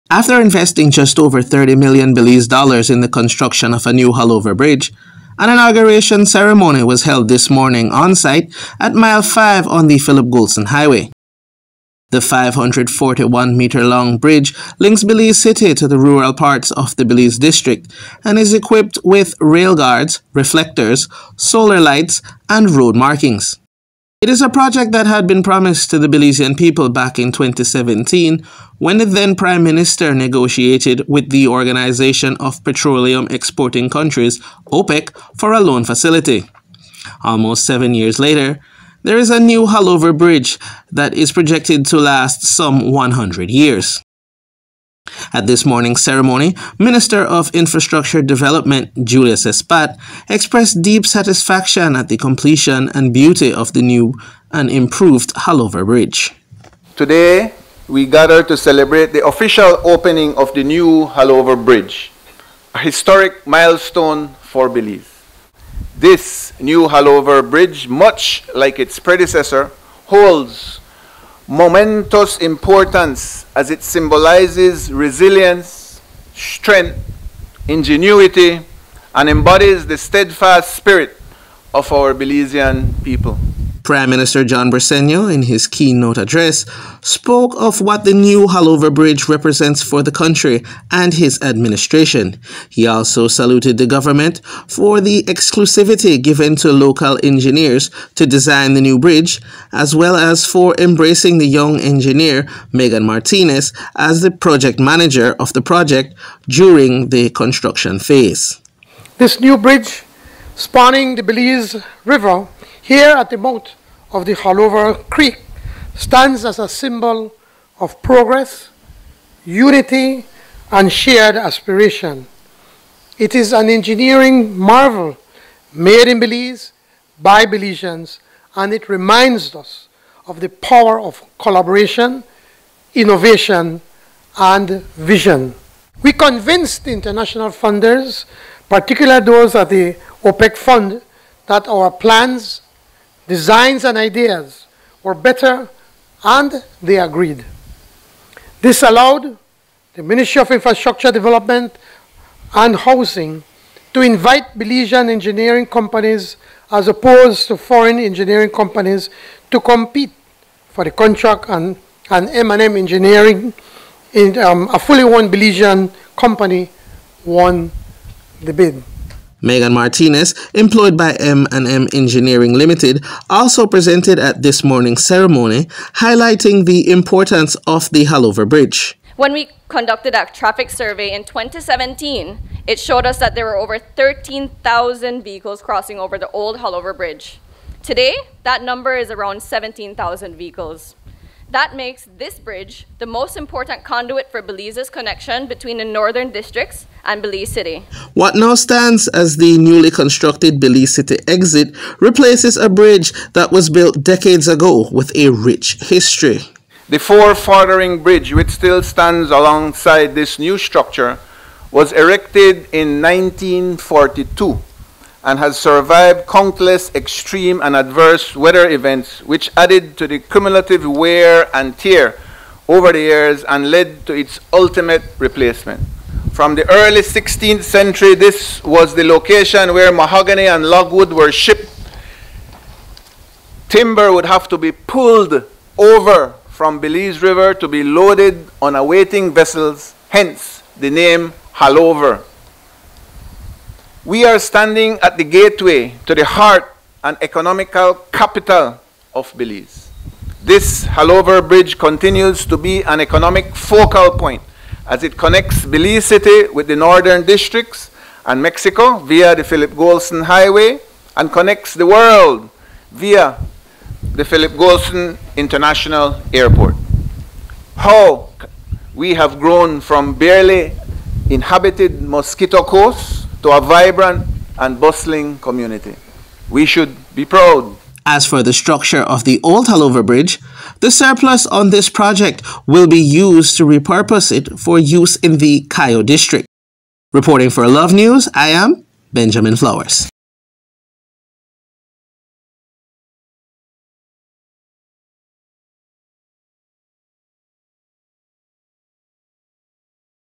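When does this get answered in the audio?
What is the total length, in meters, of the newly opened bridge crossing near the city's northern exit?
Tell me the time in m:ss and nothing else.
0:12.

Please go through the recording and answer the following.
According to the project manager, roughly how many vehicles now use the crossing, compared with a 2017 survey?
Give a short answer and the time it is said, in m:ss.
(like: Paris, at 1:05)
17,000, at 3:09.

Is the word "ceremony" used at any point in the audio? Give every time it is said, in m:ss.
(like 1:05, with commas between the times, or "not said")
0:06, 0:46, 2:55.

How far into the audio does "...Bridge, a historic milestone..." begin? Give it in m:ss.
1:01.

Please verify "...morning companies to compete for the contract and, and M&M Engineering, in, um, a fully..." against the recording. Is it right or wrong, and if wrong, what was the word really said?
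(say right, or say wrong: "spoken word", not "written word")
wrong: "engineering", not "morning".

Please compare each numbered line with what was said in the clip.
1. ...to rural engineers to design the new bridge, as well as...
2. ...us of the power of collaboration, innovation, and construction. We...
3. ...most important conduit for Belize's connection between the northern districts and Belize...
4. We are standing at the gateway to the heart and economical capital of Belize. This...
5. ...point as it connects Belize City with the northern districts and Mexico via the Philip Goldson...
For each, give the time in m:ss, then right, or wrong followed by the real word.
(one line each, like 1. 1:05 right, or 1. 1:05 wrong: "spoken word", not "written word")
1. 1:36 wrong: "local", not "rural"
2. 2:09 wrong: "vision", not "construction"
3. 3:13 right
4. 4:04 right
5. 4:14 right.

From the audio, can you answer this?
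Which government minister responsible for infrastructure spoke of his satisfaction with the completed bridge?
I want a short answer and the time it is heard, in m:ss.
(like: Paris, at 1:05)
Julius Espat, at 0:49.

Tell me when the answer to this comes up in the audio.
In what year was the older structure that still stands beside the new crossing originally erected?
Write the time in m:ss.
3:33.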